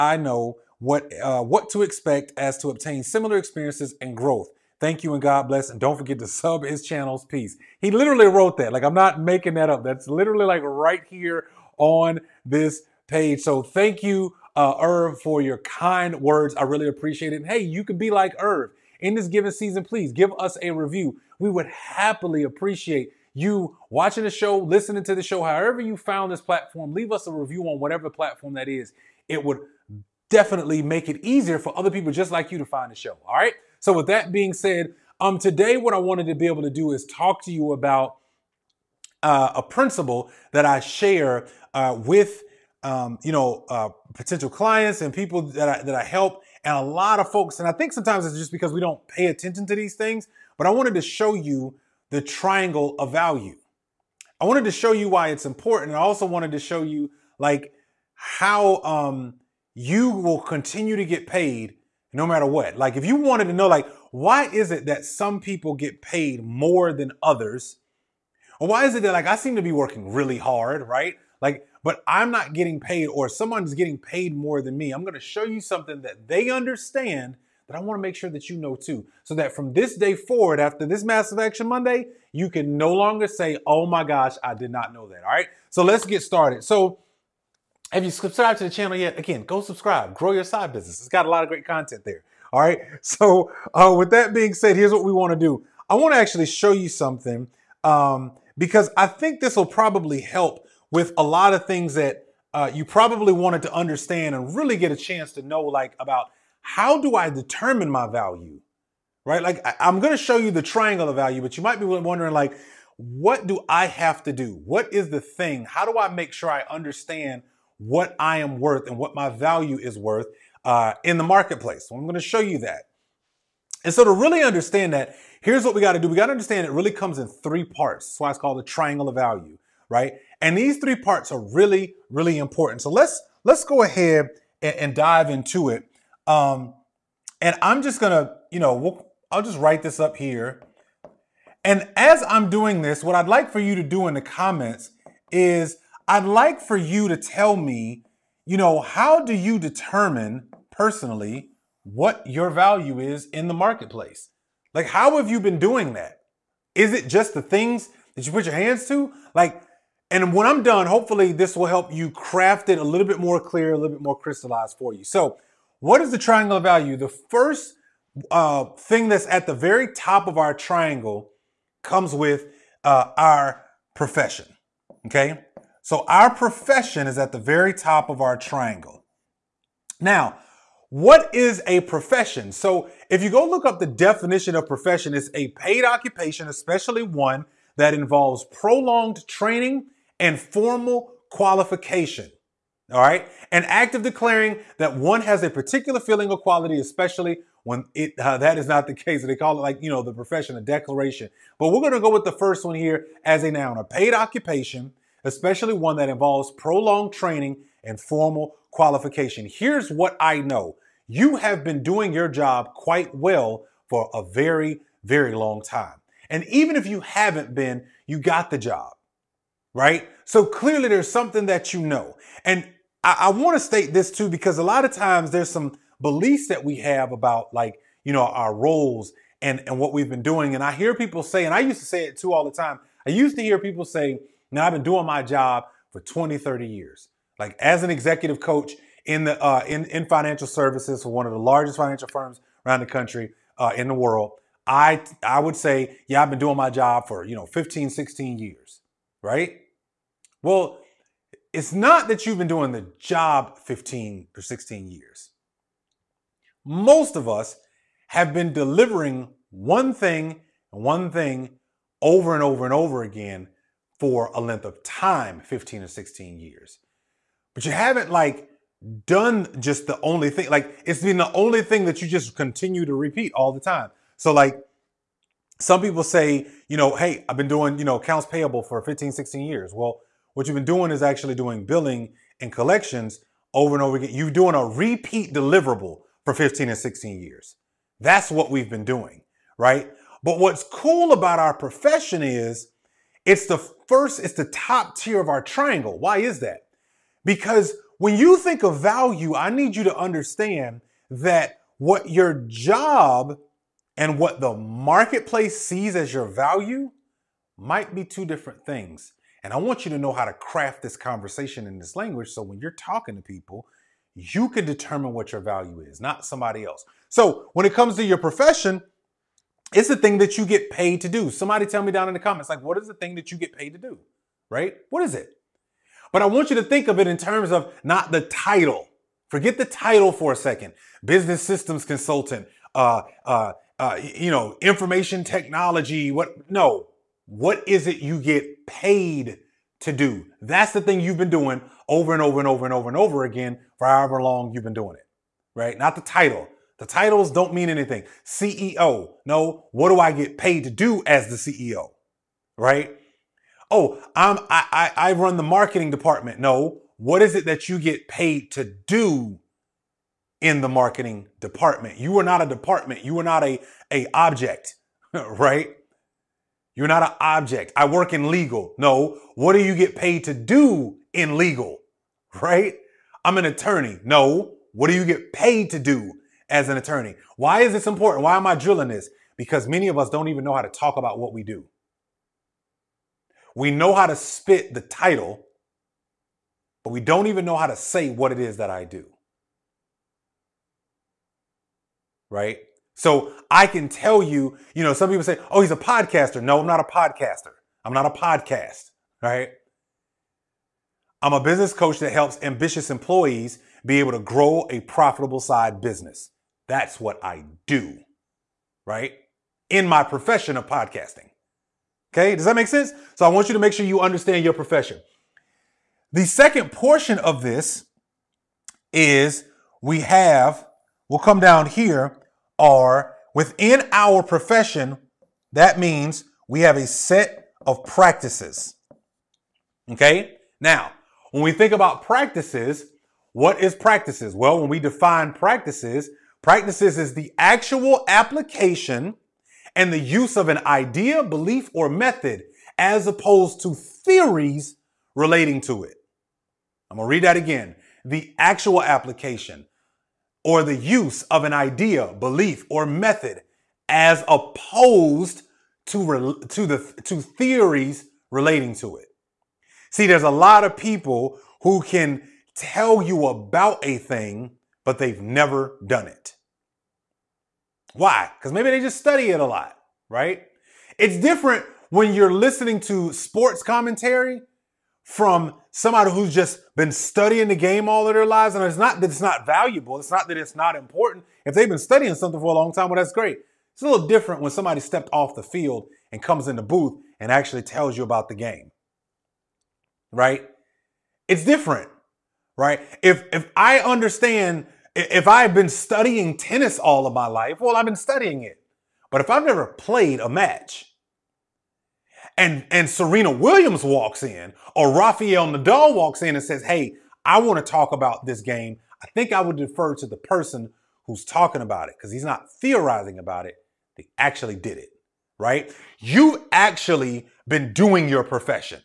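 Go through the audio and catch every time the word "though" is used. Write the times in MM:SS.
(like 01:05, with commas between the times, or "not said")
not said.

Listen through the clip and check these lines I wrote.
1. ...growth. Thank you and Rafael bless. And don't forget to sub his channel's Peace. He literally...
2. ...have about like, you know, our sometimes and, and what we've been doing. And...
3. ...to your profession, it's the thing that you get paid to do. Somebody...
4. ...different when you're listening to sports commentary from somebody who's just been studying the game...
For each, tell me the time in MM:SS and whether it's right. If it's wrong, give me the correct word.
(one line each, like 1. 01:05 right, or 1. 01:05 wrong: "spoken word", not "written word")
1. 00:04 wrong: "God", not "Rafael"
2. 03:46 wrong: "roles", not "sometimes"
3. 05:17 right
4. 07:51 right.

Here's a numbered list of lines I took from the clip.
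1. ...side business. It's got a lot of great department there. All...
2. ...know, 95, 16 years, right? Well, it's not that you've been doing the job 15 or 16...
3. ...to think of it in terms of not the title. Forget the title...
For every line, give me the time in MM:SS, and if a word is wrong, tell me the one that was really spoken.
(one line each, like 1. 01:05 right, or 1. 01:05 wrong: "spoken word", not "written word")
1. 01:30 wrong: "content", not "department"
2. 04:07 wrong: "15", not "95"
3. 05:26 right.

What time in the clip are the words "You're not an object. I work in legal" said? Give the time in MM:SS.
06:06.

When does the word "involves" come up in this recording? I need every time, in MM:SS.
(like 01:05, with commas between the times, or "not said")
03:07, 03:26.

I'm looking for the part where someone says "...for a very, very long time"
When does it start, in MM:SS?
03:33.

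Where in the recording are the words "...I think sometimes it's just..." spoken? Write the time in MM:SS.
00:47.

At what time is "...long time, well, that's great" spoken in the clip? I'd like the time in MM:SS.
08:02.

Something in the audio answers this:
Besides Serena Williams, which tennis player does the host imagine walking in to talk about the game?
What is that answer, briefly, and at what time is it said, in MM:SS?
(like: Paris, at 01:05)
Rafael Nadal, at 08:24.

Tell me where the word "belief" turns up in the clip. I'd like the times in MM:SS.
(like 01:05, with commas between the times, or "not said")
03:45, 07:21, 07:32.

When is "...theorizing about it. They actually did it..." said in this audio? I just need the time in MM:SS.
08:32.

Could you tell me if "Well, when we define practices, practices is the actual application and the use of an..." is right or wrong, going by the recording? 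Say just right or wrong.
right.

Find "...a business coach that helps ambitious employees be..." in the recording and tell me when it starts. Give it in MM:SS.
06:41.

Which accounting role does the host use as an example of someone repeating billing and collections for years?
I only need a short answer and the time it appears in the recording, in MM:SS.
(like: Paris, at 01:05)
accounts payable, at 04:37.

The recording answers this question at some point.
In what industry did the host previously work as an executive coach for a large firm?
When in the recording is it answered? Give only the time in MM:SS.
04:00.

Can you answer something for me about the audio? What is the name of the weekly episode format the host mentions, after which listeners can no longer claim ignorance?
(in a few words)
Massive Action Monday.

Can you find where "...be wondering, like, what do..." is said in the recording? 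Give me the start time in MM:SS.
01:51.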